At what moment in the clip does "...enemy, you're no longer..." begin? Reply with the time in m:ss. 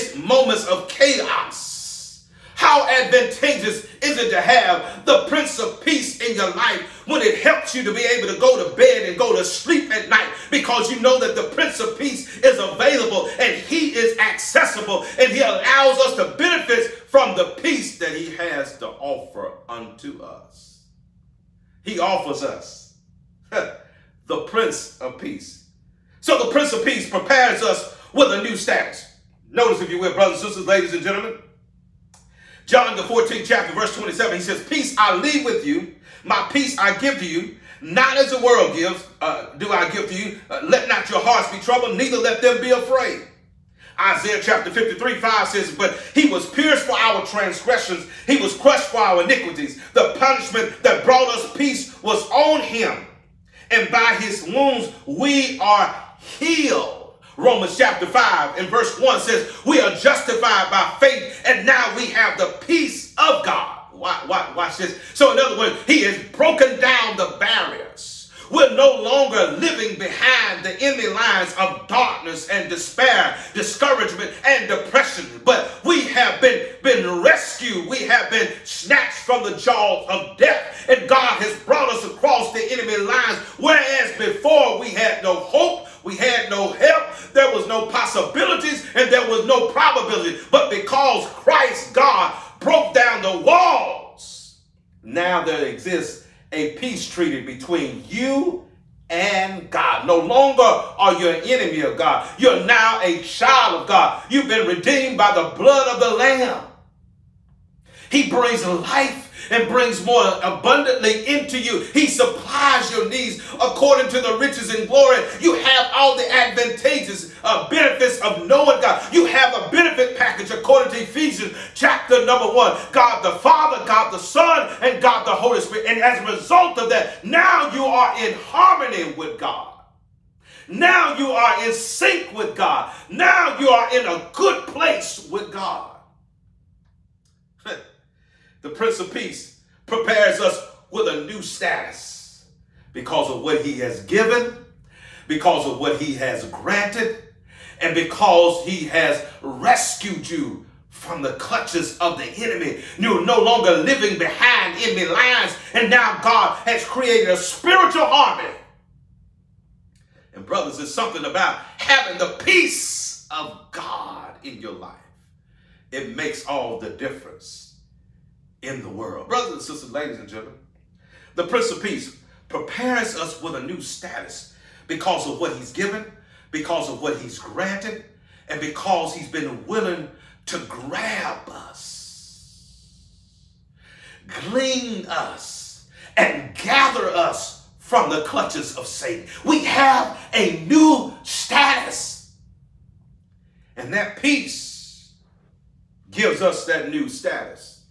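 2:32.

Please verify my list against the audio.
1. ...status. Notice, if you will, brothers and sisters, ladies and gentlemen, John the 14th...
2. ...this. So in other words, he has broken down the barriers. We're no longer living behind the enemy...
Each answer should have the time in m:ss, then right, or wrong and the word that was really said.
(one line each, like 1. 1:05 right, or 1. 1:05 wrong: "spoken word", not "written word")
1. 0:28 right
2. 1:04 right.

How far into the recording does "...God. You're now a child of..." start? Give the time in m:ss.
1:41.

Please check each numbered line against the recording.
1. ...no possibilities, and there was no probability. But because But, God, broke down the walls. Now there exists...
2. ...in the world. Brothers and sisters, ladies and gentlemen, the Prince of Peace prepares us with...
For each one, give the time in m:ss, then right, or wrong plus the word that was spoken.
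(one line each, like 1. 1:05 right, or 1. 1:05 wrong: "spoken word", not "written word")
1. 1:27 wrong: "Christ", not "But"
2. 2:48 right.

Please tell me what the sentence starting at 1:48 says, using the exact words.
He brings life and brings more abundantly into you.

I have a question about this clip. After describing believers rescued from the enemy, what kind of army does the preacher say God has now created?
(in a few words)
a spiritual army.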